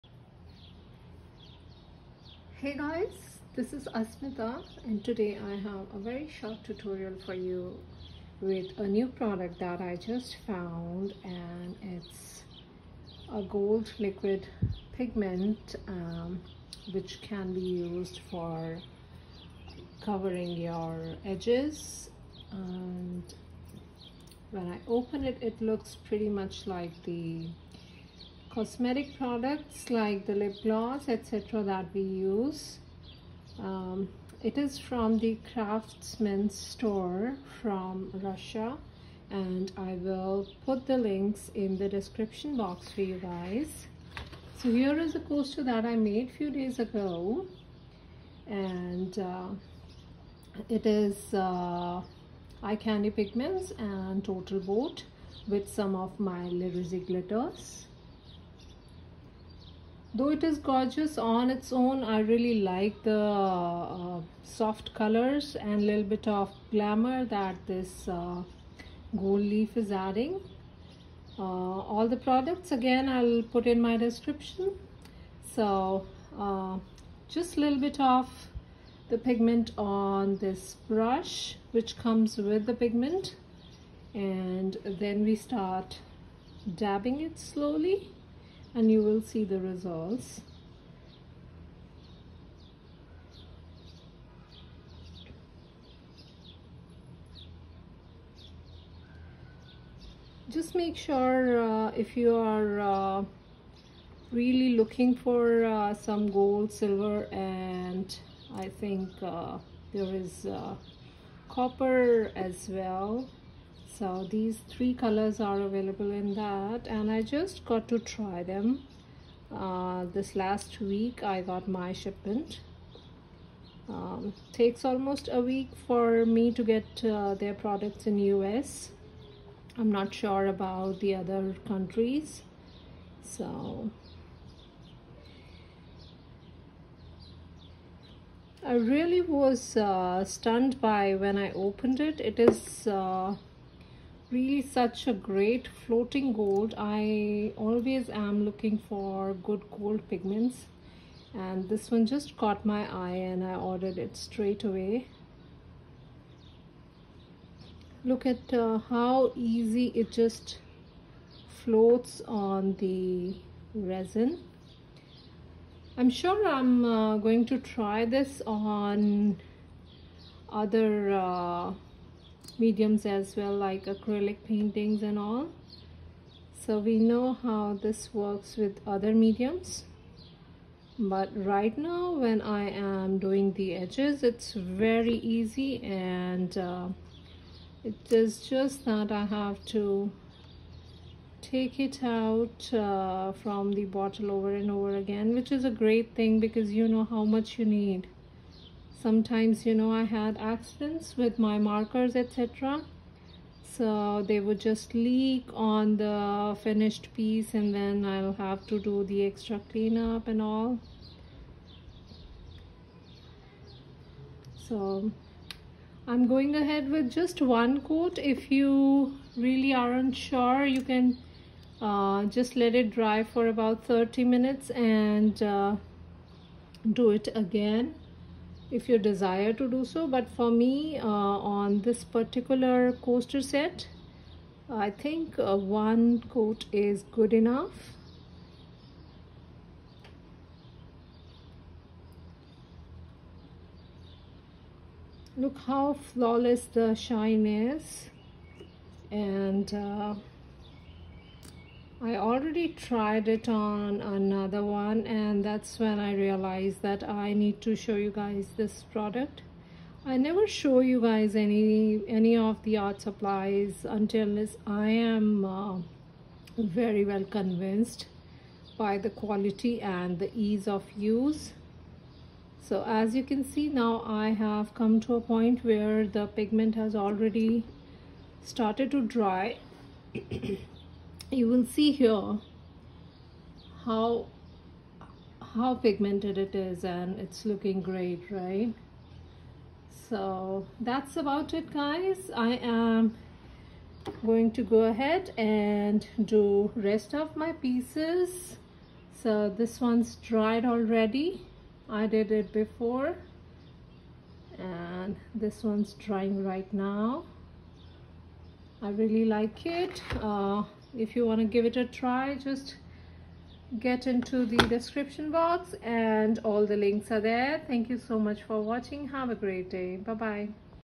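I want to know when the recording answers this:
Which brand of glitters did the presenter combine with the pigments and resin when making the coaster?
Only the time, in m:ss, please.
0:56.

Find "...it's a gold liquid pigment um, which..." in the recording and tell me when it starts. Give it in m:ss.
0:11.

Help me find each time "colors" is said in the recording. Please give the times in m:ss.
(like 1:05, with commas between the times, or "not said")
1:04, 1:54.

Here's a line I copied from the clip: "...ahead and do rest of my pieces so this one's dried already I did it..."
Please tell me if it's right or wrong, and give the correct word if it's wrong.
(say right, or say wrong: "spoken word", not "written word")
right.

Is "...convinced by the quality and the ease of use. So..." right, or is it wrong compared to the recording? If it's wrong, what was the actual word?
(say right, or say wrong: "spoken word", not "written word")
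right.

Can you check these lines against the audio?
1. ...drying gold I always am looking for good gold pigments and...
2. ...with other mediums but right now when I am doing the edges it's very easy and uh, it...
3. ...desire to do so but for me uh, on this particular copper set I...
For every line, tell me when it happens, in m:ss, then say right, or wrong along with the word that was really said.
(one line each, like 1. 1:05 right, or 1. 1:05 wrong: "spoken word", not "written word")
1. 2:25 wrong: "floating", not "drying"
2. 2:58 right
3. 3:48 wrong: "coaster", not "copper".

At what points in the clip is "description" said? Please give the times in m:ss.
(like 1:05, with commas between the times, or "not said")
0:41, 1:13, 5:14.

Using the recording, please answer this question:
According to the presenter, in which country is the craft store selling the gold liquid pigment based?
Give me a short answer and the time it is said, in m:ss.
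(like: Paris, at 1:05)
Russia, at 0:38.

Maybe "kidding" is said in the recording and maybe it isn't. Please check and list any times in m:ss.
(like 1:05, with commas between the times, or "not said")
not said.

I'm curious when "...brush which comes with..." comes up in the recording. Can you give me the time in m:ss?
1:20.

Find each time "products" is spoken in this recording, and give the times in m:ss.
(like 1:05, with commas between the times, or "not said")
0:09, 0:29, 1:12, 2:07, 4:18.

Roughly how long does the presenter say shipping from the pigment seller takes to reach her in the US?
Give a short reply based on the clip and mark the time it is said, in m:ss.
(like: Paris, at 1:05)
Almost a week, at 2:04.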